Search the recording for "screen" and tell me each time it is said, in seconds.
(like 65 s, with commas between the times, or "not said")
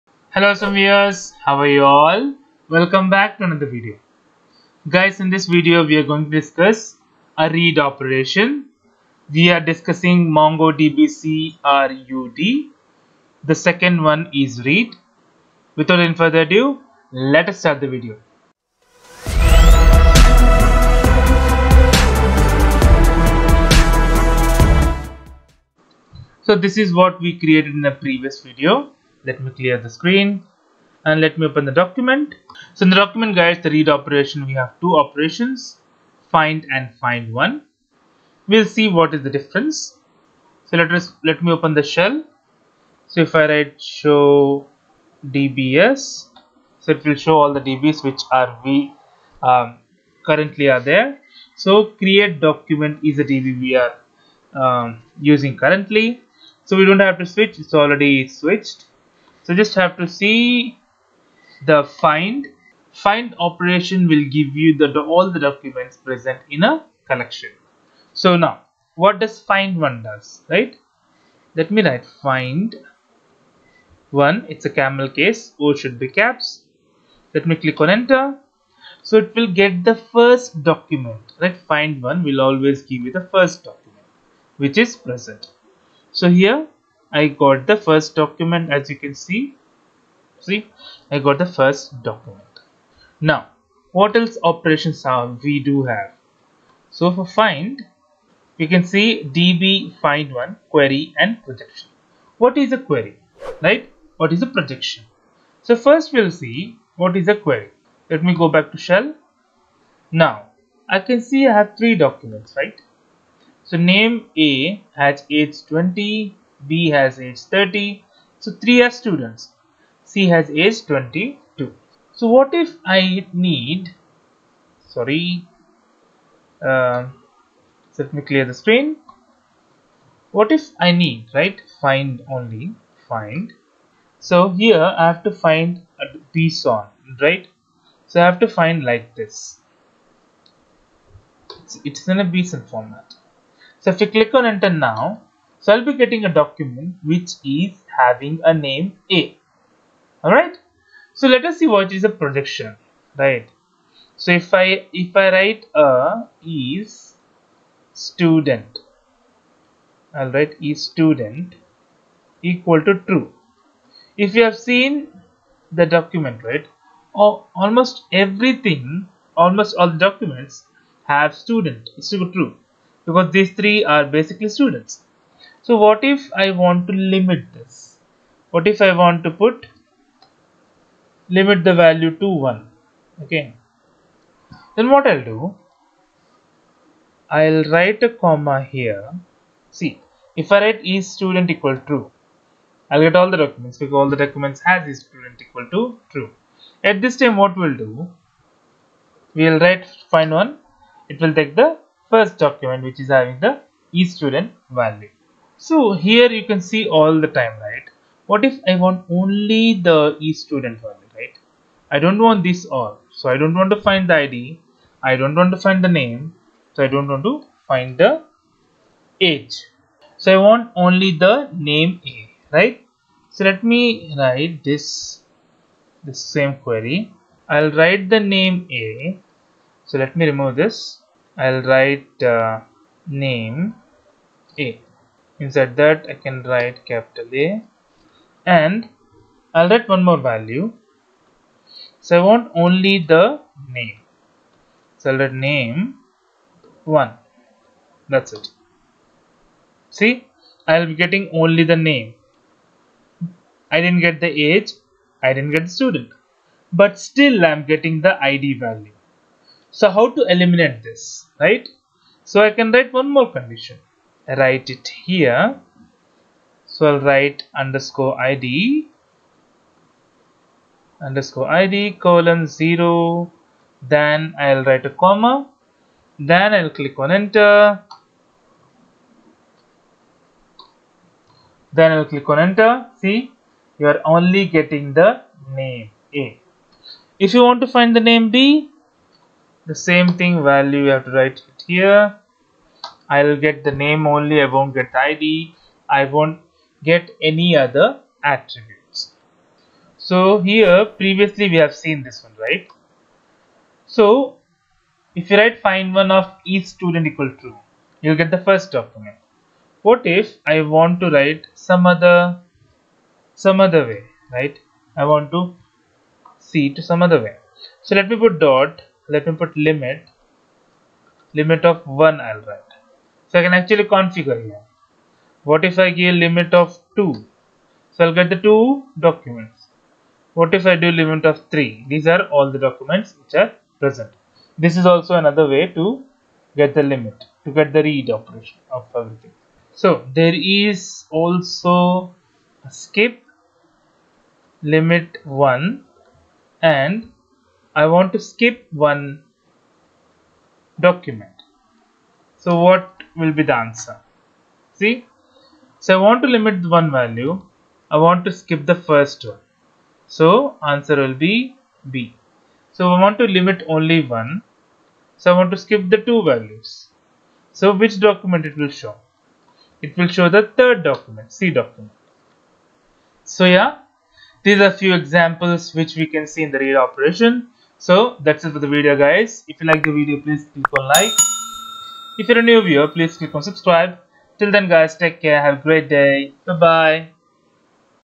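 29 s, 128 s.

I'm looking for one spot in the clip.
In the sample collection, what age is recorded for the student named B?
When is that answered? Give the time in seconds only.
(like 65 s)
116 s.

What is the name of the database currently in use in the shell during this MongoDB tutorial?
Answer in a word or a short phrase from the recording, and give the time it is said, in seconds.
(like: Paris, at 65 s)
create document, at 52 s.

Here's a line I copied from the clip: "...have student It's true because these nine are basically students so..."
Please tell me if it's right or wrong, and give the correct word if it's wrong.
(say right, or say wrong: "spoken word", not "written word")
wrong: "three", not "nine".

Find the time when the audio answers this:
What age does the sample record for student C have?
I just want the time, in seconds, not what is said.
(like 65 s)
120 s.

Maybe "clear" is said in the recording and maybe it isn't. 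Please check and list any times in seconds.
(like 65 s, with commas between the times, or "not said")
29 s, 128 s.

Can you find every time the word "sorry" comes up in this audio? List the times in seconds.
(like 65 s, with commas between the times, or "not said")
124 s.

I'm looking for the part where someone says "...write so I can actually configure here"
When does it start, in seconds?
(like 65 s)
322 s.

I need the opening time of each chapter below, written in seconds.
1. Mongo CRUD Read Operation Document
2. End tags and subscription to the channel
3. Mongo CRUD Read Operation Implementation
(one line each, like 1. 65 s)
1. 32 s
2. 377 s
3. 42 s.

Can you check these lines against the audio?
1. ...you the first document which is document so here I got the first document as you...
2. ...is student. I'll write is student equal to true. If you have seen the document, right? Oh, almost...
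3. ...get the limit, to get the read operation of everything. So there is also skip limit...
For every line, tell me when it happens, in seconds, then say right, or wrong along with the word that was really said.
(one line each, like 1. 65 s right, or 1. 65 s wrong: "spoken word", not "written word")
1. 83 s wrong: "present", not "document"
2. 156 s right
3. 336 s right.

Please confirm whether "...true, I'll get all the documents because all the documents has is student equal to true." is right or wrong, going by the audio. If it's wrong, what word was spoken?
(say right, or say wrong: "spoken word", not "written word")
right.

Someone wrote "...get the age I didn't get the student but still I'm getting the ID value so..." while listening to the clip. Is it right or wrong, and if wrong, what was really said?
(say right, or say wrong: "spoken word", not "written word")
right.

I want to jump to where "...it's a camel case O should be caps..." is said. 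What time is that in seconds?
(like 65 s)
74 s.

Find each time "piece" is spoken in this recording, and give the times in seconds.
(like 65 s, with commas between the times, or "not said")
136 s.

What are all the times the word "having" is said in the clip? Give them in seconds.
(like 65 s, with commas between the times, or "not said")
147 s, 203 s.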